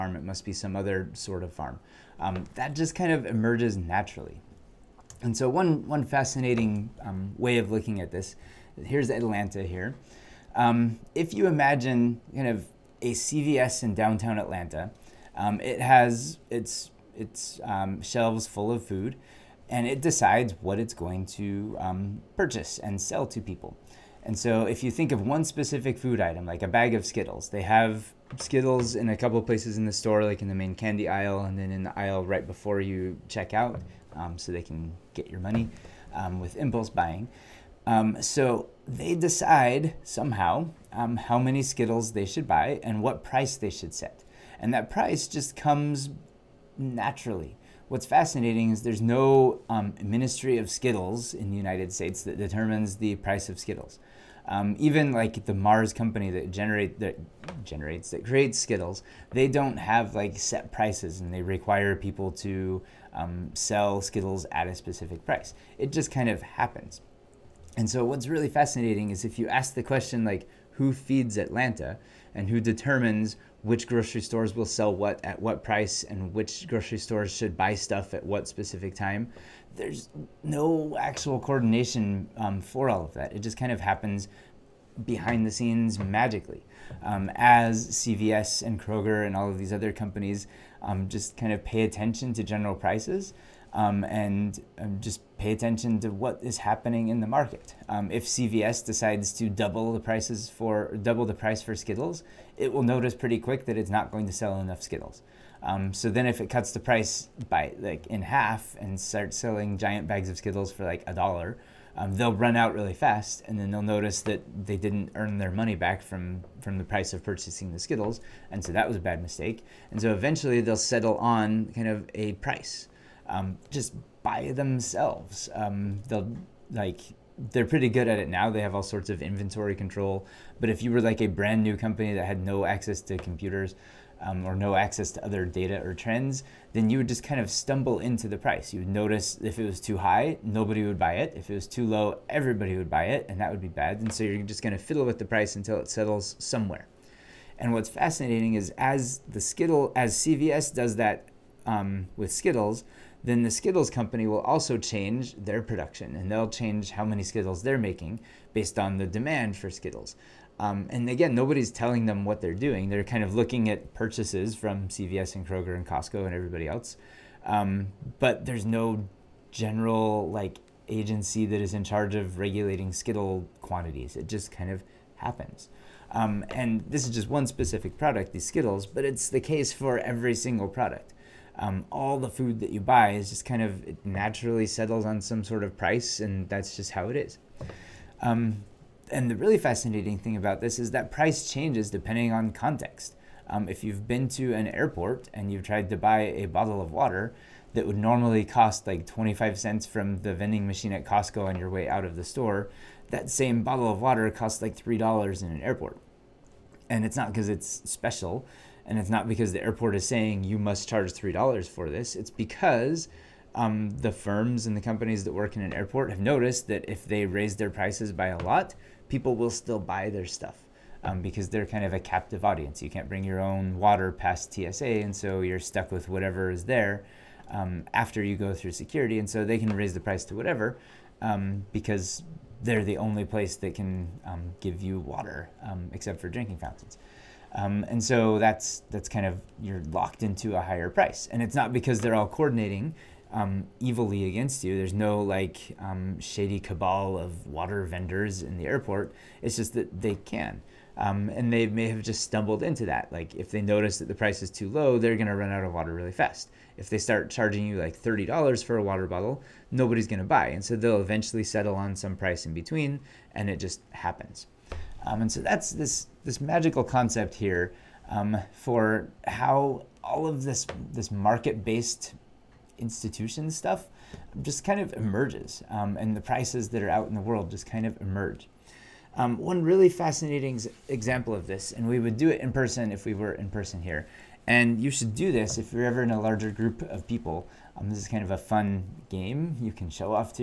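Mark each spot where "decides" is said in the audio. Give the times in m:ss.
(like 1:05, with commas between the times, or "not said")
0:19, 0:39, 1:38.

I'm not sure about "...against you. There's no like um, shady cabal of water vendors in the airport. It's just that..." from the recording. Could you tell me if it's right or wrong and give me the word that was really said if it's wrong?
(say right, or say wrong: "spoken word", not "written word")
right.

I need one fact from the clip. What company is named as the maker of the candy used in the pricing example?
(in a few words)
Mars.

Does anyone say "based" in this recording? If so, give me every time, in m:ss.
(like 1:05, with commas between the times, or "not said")
2:38, 4:31.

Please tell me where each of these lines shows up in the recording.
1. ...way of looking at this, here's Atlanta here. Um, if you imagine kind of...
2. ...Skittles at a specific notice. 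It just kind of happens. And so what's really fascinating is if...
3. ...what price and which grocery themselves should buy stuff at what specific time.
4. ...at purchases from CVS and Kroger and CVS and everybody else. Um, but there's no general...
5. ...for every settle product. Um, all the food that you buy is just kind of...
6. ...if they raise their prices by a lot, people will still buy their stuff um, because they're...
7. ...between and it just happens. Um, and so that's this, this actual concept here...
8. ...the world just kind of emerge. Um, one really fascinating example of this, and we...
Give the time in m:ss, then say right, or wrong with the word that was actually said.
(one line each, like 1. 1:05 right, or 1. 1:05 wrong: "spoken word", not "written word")
1. 0:07 right
2. 1:04 wrong: "price", not "notice"
3. 1:15 wrong: "stores", not "themselves"
4. 2:43 wrong: "Costco", not "CVS"
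5. 2:59 wrong: "single", not "settle"
6. 3:36 right
7. 4:22 wrong: "magical", not "actual"
8. 4:37 right.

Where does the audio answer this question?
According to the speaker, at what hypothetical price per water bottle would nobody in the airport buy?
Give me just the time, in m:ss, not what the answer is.
4:17.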